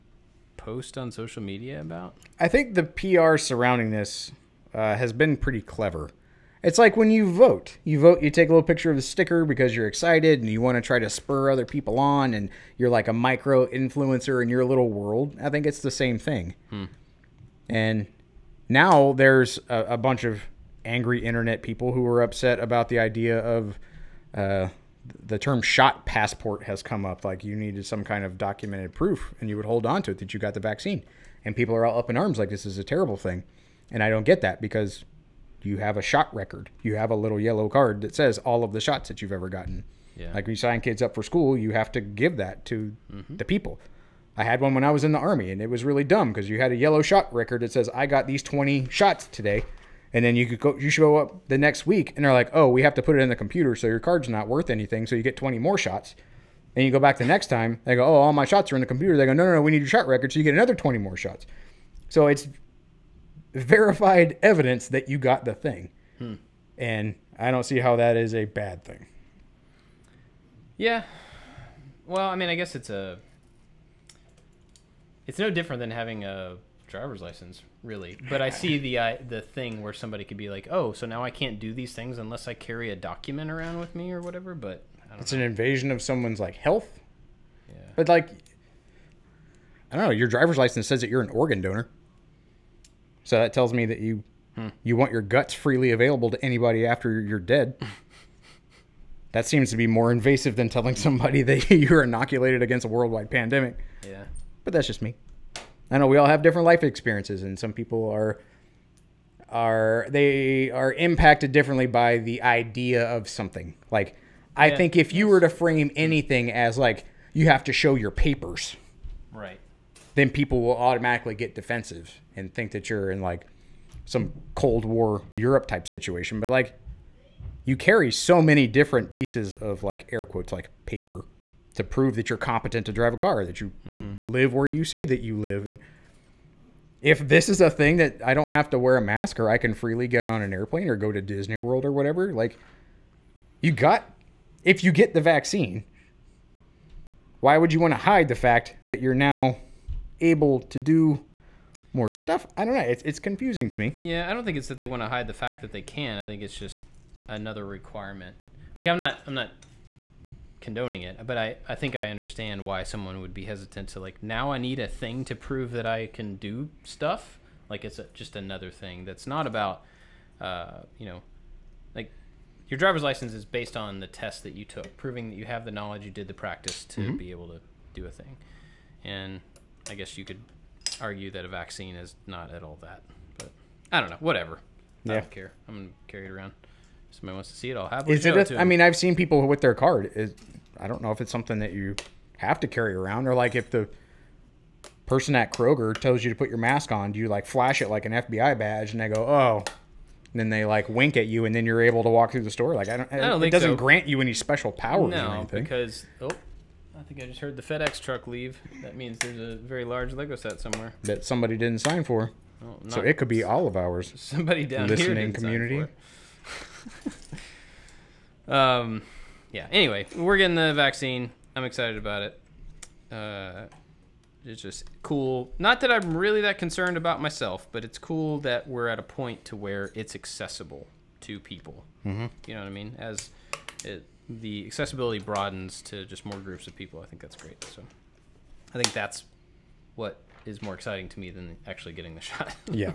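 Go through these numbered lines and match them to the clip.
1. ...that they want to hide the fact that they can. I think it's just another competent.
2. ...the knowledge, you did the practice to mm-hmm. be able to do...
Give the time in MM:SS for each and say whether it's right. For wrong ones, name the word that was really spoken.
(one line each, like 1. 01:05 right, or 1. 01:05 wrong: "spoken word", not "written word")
1. 02:34 wrong: "requirement", not "competent"
2. 02:55 right.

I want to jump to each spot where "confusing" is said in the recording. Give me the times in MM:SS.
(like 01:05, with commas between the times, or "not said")
02:33.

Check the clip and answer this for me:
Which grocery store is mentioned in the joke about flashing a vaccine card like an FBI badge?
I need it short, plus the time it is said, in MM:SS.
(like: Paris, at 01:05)
Kroger, at 03:15.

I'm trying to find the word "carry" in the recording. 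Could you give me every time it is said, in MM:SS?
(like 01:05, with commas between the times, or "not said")
01:22, 02:07, 03:06, 03:12.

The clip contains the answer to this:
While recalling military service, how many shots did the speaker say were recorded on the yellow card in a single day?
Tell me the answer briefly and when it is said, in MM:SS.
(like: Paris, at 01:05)
20, at 00:48.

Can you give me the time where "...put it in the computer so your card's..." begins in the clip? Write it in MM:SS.
00:53.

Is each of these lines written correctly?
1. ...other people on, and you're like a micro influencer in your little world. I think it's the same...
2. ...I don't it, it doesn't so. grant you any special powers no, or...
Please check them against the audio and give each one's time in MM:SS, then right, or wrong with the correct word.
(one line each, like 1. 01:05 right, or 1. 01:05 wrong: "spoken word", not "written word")
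1. 00:11 right
2. 03:23 right.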